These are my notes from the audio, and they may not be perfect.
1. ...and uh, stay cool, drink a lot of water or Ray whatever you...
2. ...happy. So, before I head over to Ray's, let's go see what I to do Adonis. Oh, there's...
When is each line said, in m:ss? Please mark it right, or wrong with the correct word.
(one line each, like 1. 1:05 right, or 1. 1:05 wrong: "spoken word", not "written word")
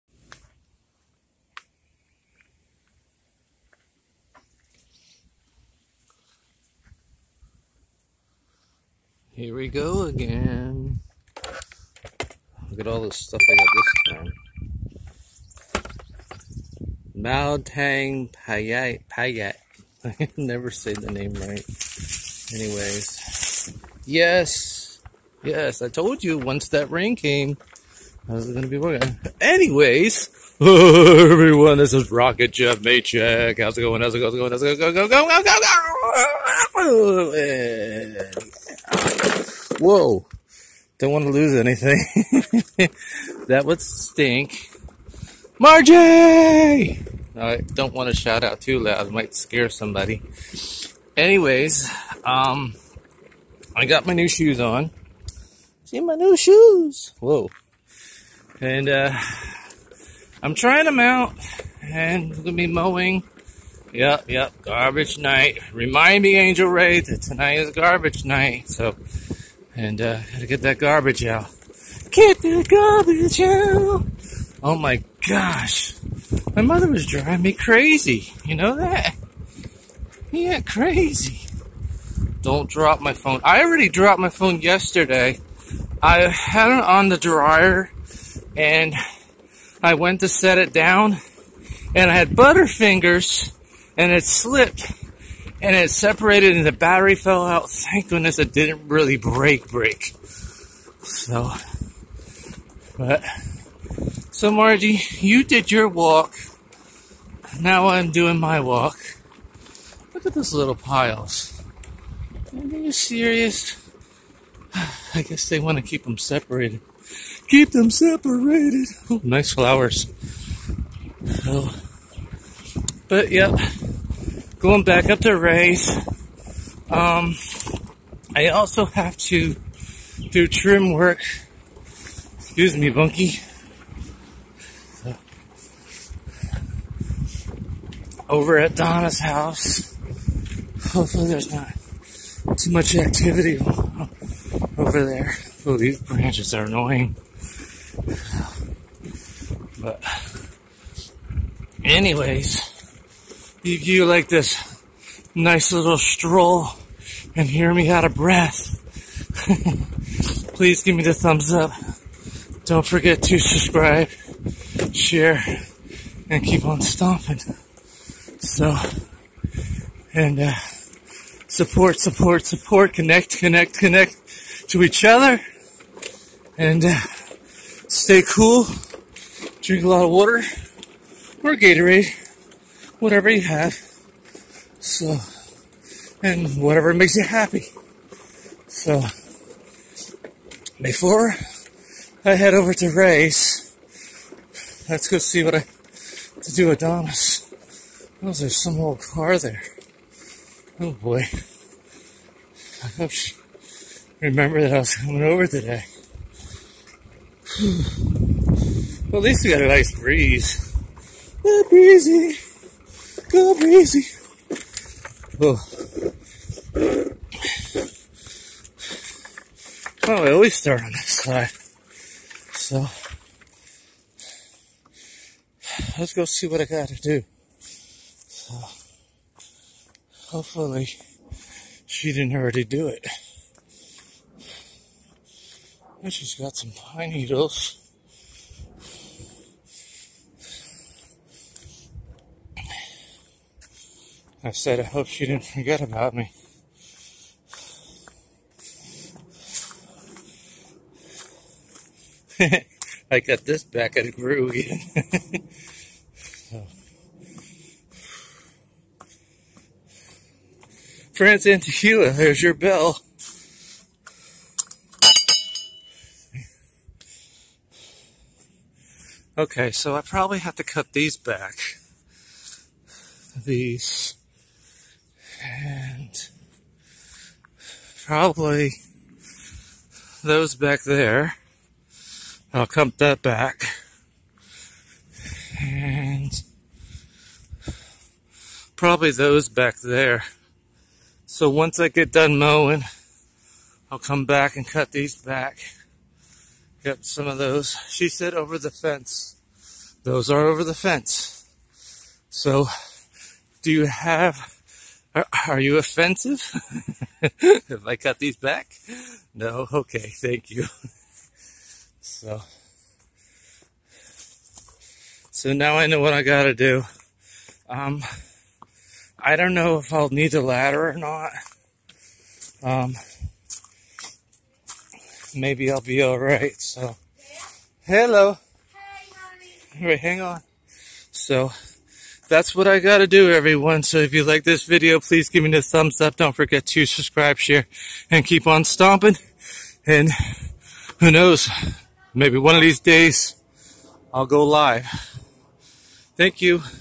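1. 2:56 wrong: "Gatorade", not "Ray"
2. 3:07 right.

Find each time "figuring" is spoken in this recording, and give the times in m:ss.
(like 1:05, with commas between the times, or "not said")
not said.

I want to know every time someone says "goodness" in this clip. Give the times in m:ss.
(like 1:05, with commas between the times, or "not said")
1:38.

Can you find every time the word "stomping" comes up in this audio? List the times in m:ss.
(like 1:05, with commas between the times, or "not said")
2:46, 5:38.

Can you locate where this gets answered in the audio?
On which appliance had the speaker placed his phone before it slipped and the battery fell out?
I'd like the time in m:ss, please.
1:27.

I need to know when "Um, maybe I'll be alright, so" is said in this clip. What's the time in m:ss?
5:22.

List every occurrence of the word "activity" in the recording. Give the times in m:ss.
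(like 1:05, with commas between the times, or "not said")
2:22.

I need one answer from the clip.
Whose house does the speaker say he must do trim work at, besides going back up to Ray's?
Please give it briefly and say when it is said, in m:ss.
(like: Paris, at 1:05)
Donna's, at 2:18.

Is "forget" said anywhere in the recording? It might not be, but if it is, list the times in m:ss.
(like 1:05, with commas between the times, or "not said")
2:42, 4:05, 5:36.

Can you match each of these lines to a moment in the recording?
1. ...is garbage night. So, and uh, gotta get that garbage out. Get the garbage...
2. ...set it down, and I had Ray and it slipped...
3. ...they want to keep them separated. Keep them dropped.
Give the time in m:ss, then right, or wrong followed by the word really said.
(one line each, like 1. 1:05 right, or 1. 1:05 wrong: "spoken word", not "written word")
1. 1:07 right
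2. 1:30 wrong: "Butterfingers", not "Ray"
3. 1:55 wrong: "separated", not "dropped".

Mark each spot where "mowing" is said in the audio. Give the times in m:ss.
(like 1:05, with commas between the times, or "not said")
1:02, 4:52.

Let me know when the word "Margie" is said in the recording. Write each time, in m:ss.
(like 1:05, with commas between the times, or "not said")
0:45, 1:44.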